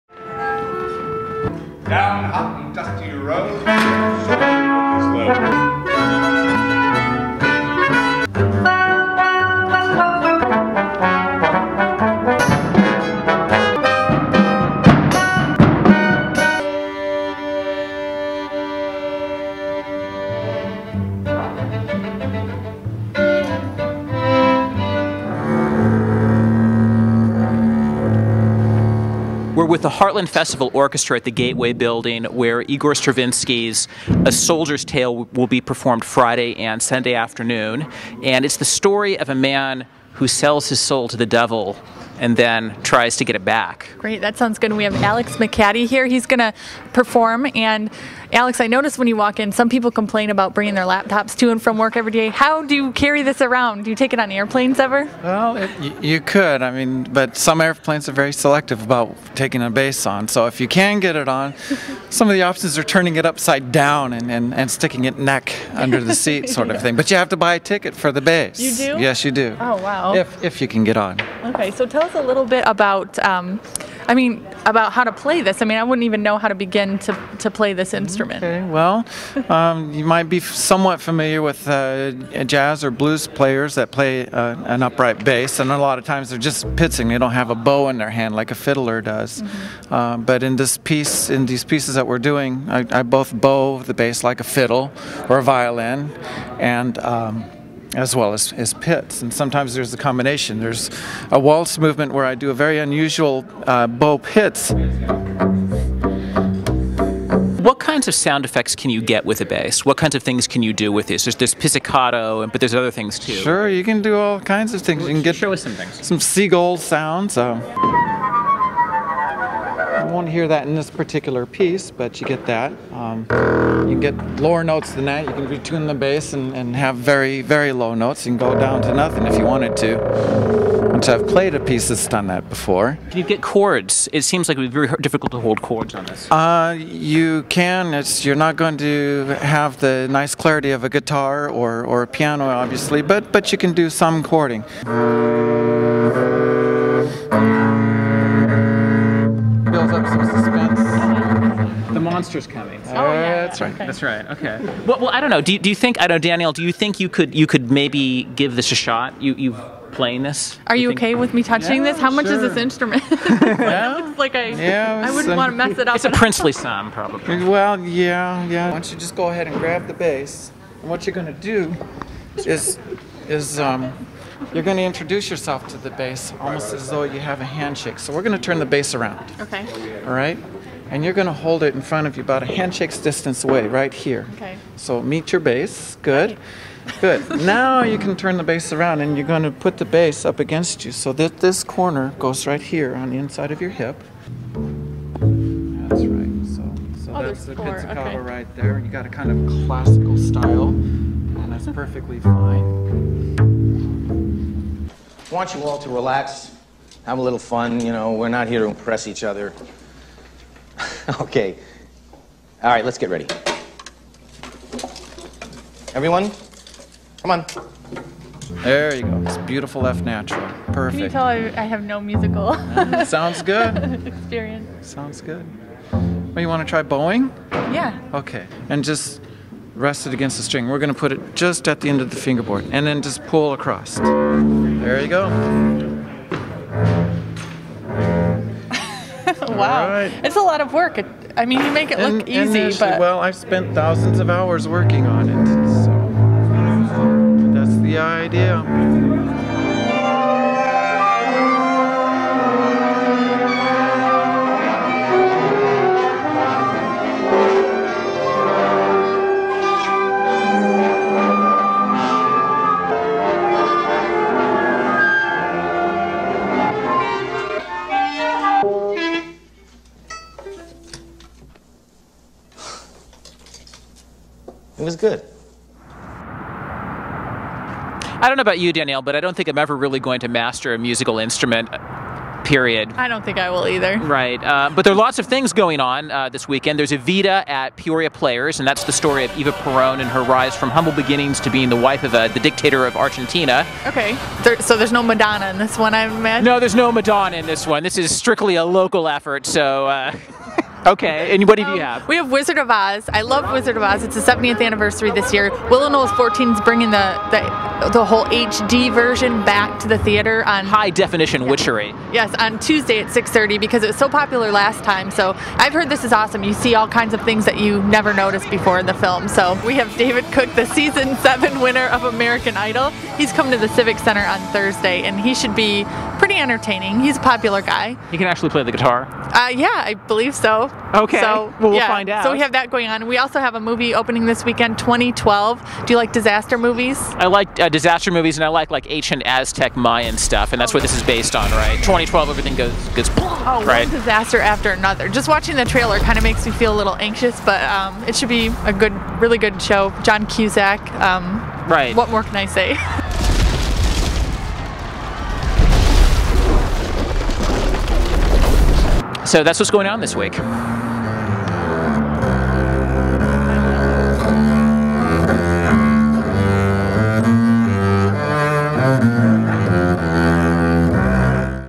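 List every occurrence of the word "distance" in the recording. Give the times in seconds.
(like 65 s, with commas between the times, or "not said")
182 s.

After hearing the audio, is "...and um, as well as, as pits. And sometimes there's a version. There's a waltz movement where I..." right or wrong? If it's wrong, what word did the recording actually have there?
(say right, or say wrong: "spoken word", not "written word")
wrong: "combination", not "version".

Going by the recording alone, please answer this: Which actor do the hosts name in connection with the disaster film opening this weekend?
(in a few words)
John Cusack.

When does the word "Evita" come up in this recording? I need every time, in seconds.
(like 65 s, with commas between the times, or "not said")
286 s.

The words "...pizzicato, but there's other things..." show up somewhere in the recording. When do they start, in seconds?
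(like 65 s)
111 s.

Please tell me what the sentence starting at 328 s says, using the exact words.
He can actually play the guitar.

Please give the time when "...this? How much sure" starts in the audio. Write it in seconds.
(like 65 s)
161 s.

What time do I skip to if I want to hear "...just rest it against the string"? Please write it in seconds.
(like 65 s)
228 s.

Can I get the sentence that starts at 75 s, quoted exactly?
I mean, I wouldn't even know how to begin to, to play this instrument.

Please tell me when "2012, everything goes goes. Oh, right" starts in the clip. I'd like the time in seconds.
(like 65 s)
341 s.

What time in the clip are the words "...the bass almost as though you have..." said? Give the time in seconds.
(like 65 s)
175 s.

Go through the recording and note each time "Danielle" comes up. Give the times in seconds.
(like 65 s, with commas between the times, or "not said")
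156 s, 278 s.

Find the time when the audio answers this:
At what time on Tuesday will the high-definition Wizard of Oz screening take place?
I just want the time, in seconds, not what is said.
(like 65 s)
313 s.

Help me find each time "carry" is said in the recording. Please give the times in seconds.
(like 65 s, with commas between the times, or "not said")
52 s.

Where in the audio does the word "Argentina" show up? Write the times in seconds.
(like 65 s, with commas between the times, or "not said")
292 s.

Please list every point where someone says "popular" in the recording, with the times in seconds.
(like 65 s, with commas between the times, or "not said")
314 s, 327 s.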